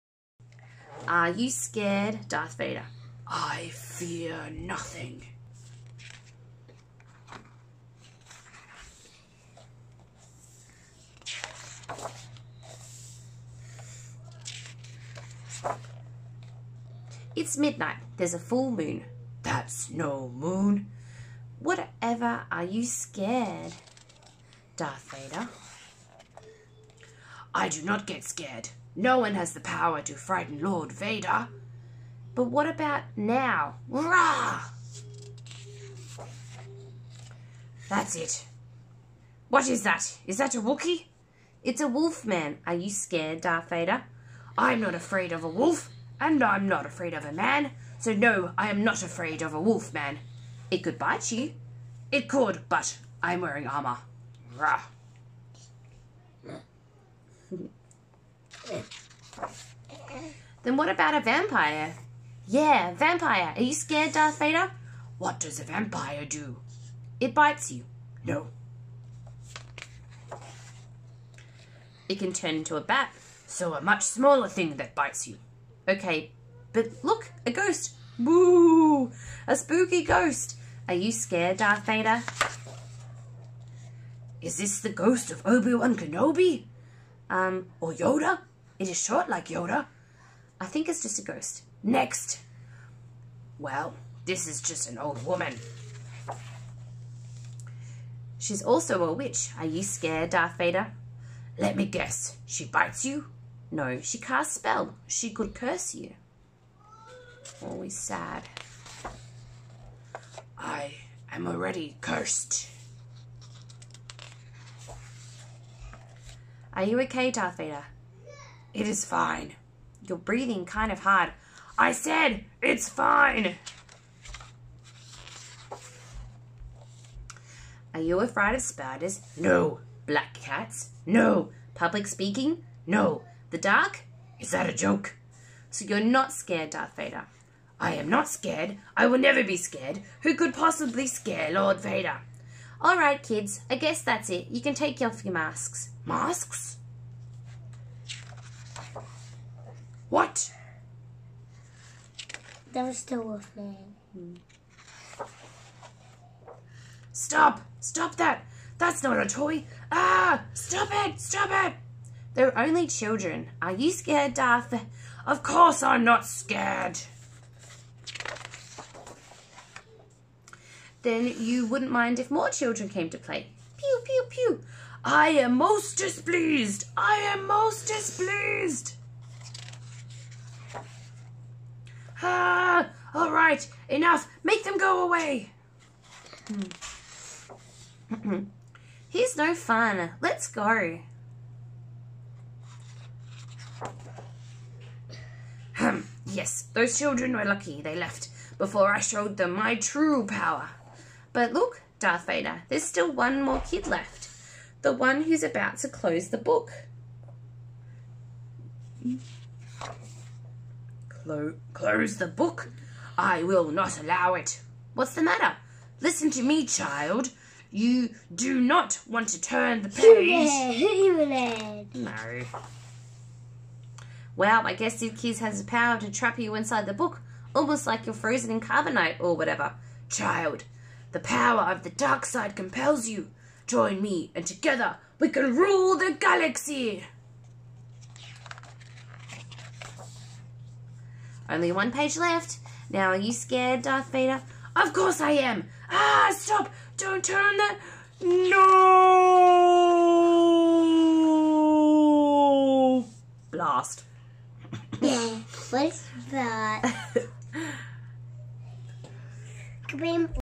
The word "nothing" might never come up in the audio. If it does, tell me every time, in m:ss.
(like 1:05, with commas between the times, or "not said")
0:04.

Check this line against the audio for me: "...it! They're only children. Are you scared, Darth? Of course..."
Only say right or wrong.
right.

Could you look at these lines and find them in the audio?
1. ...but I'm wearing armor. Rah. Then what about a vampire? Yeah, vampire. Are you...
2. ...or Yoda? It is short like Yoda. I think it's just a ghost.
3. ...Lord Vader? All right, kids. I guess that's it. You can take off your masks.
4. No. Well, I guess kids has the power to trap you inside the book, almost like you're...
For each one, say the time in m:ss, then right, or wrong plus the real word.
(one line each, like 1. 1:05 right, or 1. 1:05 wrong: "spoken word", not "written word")
1. 0:52 right
2. 1:27 right
3. 2:21 right
4. 3:41 right.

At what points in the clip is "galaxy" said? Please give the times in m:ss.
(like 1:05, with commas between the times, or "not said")
3:56.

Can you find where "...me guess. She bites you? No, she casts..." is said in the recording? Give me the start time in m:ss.
1:41.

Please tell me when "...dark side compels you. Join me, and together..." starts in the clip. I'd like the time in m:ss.
3:51.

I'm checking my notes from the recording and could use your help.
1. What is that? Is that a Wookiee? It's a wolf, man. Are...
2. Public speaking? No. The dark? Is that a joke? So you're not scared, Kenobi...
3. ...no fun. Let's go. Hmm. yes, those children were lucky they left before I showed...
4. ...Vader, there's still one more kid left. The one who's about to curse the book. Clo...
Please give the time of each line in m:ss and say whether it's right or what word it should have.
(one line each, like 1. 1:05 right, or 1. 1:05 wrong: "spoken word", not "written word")
1. 0:39 right
2. 2:11 wrong: "Darth", not "Kenobi"
3. 3:09 right
4. 3:22 wrong: "close", not "curse".